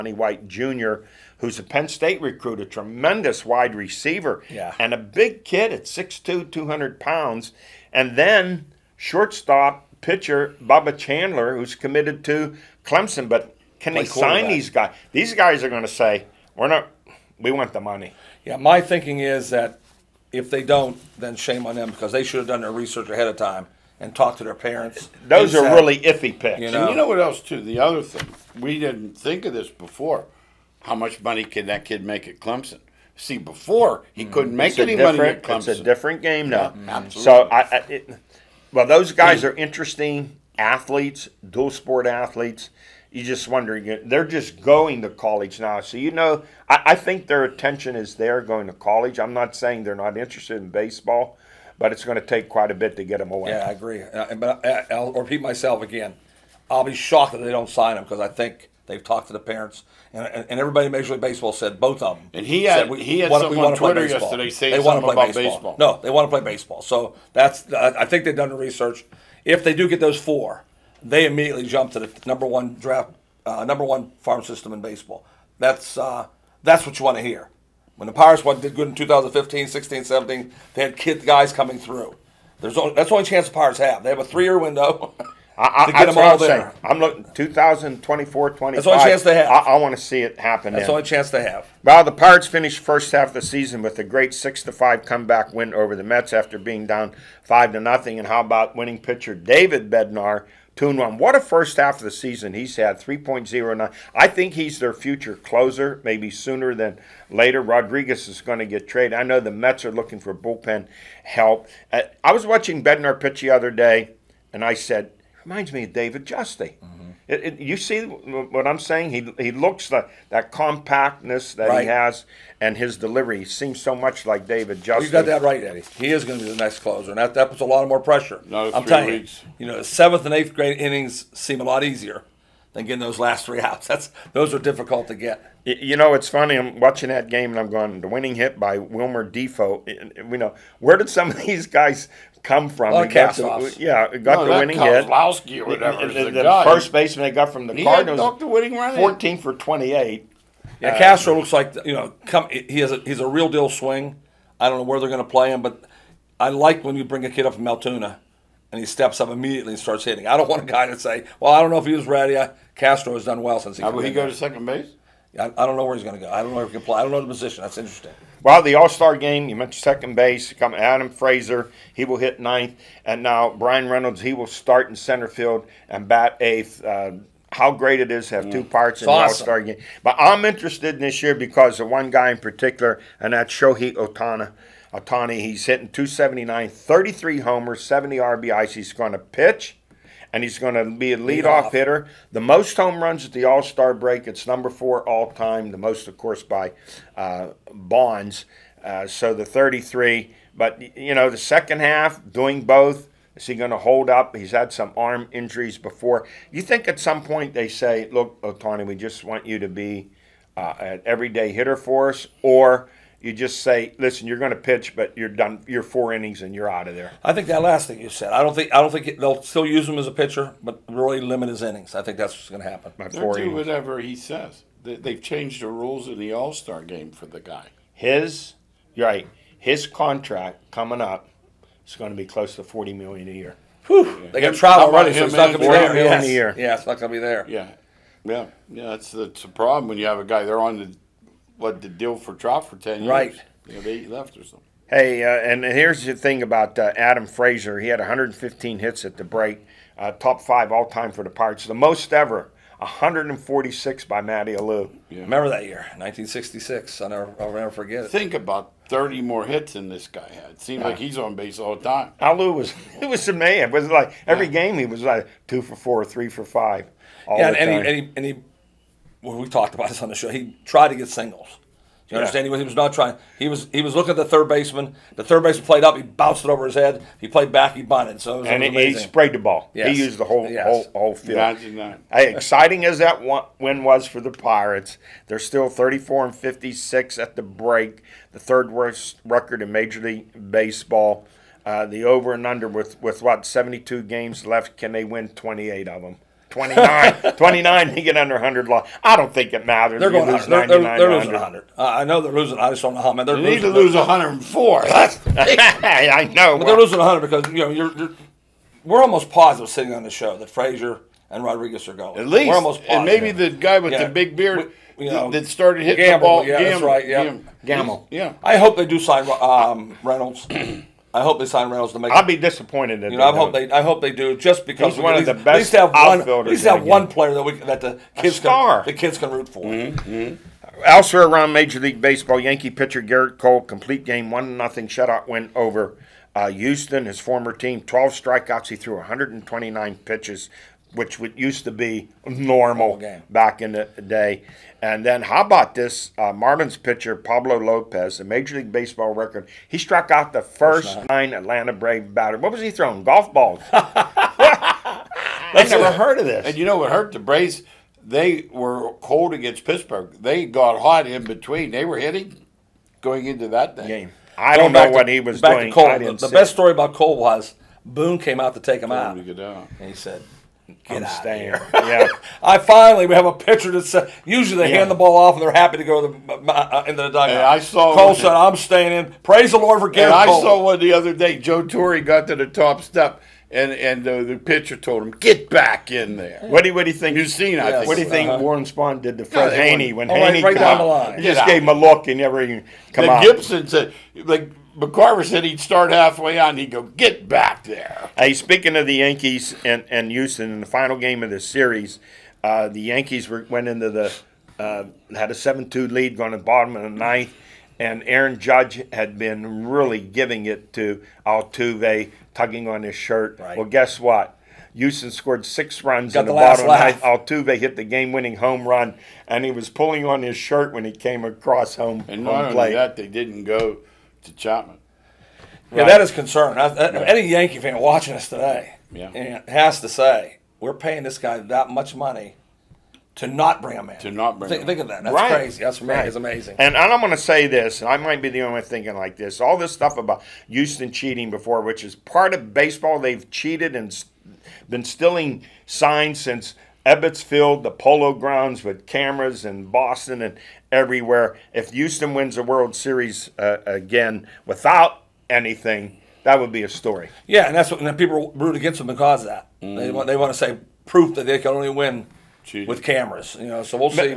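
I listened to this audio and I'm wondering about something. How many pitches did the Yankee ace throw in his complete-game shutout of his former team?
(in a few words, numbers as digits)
129.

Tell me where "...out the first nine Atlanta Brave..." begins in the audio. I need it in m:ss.
5:50.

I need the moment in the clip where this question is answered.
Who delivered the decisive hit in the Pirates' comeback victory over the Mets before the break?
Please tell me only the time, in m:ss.
2:18.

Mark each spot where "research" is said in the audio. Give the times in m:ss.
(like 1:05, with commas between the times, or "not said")
0:22, 1:08.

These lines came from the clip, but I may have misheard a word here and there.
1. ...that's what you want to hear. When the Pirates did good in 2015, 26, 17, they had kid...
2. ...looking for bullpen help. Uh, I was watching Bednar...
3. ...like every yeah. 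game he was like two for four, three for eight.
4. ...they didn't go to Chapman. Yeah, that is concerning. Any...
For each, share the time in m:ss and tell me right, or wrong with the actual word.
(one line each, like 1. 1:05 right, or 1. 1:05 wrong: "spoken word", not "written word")
1. 1:16 wrong: "16", not "26"
2. 1:49 right
3. 4:23 wrong: "five", not "eight"
4. 7:02 right.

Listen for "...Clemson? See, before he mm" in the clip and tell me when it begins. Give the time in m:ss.
0:32.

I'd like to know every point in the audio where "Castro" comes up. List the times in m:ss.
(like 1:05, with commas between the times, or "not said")
2:30, 2:42.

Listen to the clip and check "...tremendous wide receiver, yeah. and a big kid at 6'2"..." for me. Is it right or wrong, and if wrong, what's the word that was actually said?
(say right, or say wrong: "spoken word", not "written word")
right.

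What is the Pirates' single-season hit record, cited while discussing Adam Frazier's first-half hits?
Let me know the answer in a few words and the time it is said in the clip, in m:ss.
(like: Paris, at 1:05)
146, at 4:12.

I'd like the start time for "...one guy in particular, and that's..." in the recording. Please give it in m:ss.
3:01.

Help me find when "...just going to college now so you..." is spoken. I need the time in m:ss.
0:44.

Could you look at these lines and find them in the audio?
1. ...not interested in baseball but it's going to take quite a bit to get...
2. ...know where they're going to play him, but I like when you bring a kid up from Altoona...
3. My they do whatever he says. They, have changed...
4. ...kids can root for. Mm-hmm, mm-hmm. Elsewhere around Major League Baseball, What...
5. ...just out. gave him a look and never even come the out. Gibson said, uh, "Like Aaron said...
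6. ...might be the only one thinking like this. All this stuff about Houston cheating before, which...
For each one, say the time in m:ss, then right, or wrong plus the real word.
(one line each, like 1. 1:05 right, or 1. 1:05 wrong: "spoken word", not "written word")
1. 0:49 right
2. 2:34 right
3. 3:42 right
4. 5:28 wrong: "Yankee", not "What"
5. 6:31 wrong: "McCarver", not "Aaron"
6. 7:17 right.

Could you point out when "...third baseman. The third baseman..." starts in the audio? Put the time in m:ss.
4:34.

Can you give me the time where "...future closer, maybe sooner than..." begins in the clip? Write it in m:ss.
1:44.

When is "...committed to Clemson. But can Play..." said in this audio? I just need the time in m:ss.
0:11.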